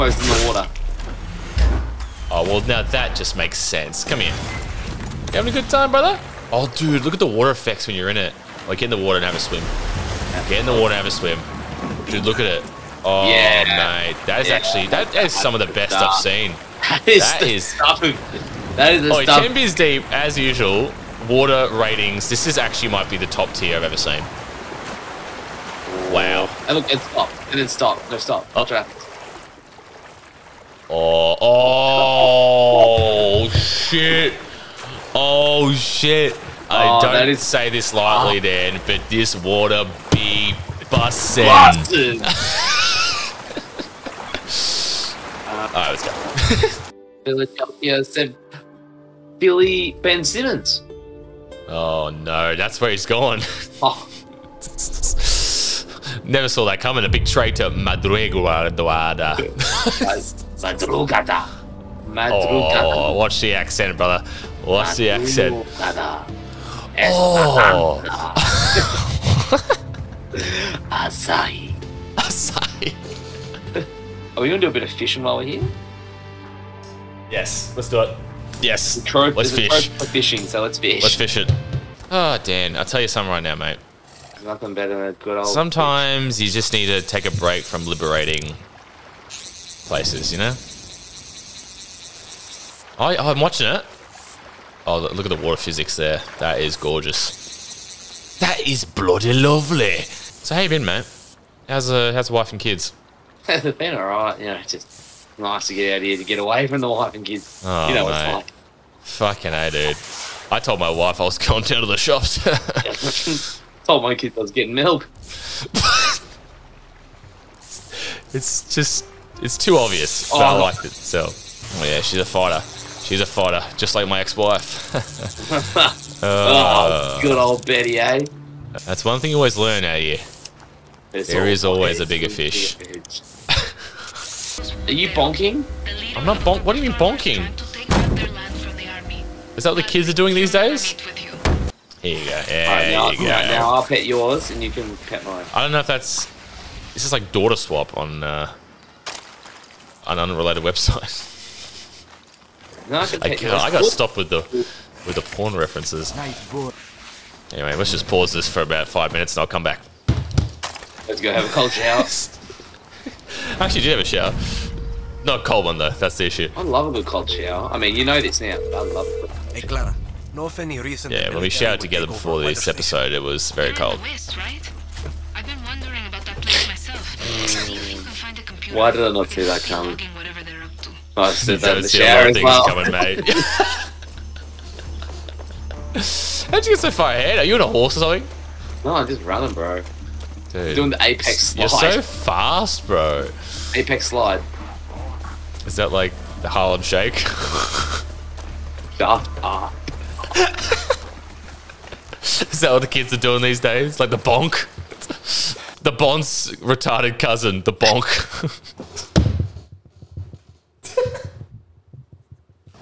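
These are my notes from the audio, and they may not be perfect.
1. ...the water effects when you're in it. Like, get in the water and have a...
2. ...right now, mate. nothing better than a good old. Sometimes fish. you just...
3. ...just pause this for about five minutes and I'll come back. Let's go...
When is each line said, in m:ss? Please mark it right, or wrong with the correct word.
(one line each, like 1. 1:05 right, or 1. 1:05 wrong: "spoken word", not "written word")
1. 0:07 right
2. 1:23 right
3. 2:37 right.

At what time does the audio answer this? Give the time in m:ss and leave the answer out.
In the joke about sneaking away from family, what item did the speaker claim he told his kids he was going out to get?
1:54.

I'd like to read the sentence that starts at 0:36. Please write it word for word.
I oh, don't is, say this lightly, oh.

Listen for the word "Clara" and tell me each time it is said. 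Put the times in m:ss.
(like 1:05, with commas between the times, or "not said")
2:49.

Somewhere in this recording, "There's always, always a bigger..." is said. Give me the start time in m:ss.
2:11.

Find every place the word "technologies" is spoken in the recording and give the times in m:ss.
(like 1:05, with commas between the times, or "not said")
not said.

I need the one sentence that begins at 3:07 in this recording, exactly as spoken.
Are you on a horse or something?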